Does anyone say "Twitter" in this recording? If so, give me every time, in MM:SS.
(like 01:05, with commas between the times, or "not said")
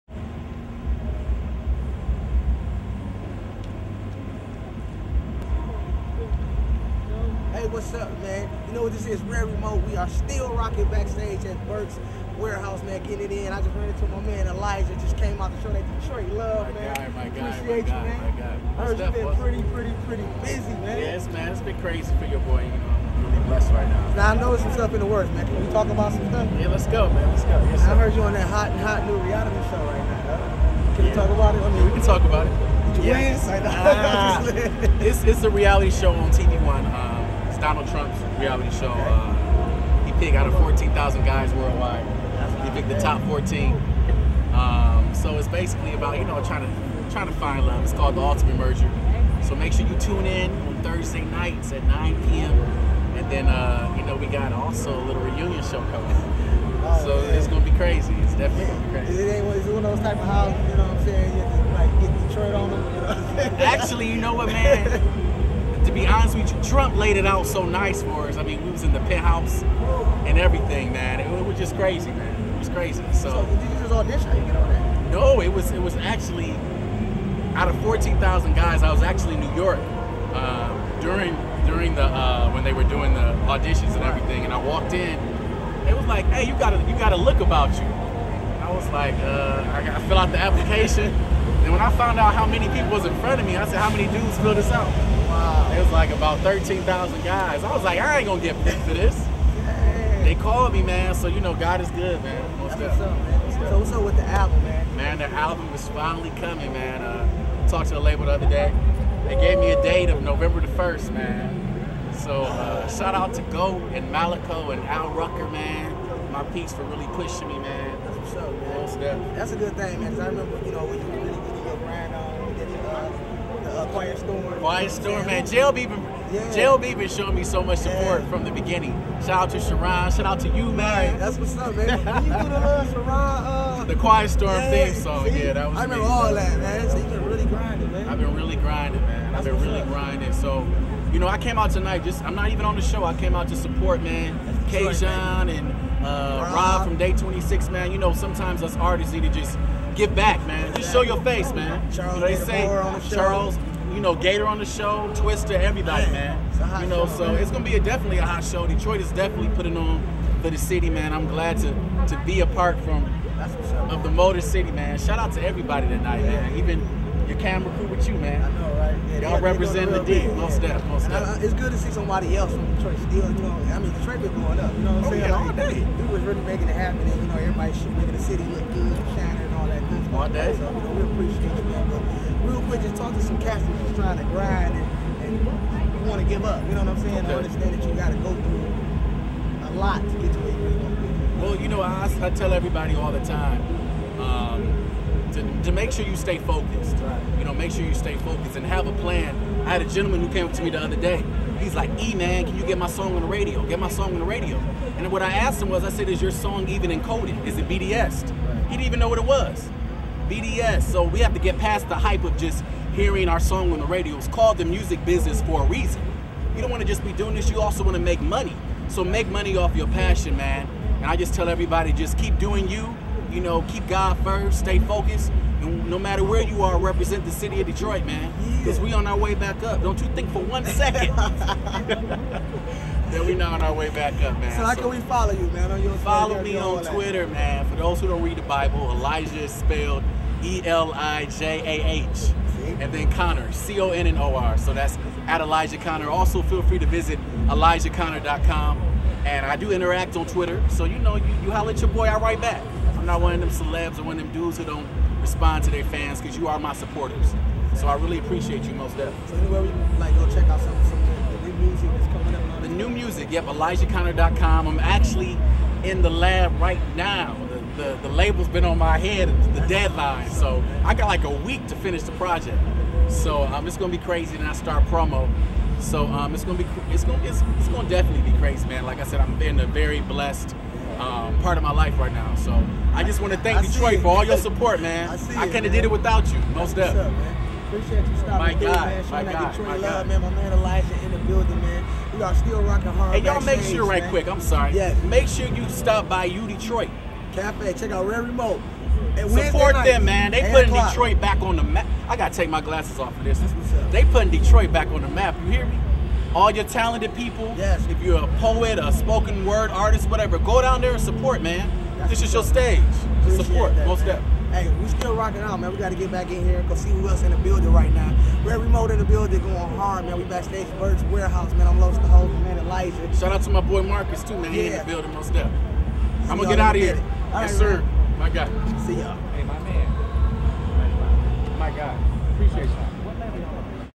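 03:56, 04:10.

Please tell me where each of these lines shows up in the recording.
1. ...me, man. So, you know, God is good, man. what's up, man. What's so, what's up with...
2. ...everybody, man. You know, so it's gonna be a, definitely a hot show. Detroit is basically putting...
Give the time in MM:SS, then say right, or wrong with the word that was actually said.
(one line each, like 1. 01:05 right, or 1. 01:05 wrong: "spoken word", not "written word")
1. 01:40 right
2. 02:35 wrong: "definitely", not "basically".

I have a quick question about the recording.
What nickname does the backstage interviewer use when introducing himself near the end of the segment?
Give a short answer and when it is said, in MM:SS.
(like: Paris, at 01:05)
Los the Host, at 05:21.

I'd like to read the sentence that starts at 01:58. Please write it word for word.
That's, that's a good thing, man.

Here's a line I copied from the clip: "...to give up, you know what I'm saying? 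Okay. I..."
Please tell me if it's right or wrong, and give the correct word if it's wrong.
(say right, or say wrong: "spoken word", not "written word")
right.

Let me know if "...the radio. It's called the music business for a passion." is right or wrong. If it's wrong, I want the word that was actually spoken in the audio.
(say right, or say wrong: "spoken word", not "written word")
wrong: "reason", not "passion".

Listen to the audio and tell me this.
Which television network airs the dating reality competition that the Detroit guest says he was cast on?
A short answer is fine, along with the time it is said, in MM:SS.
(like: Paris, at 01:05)
TV One, at 00:36.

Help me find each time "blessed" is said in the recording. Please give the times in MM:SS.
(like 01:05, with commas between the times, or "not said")
00:23, 04:40.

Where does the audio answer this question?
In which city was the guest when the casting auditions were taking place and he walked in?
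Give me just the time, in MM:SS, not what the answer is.
01:19.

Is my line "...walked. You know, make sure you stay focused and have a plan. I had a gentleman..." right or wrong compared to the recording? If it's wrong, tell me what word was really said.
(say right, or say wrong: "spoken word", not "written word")
wrong: "focused", not "walked".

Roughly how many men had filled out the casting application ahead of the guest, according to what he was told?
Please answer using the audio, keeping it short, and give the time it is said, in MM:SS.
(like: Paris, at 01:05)
13,000, at 01:36.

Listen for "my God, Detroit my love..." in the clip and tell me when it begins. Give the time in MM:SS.
04:49.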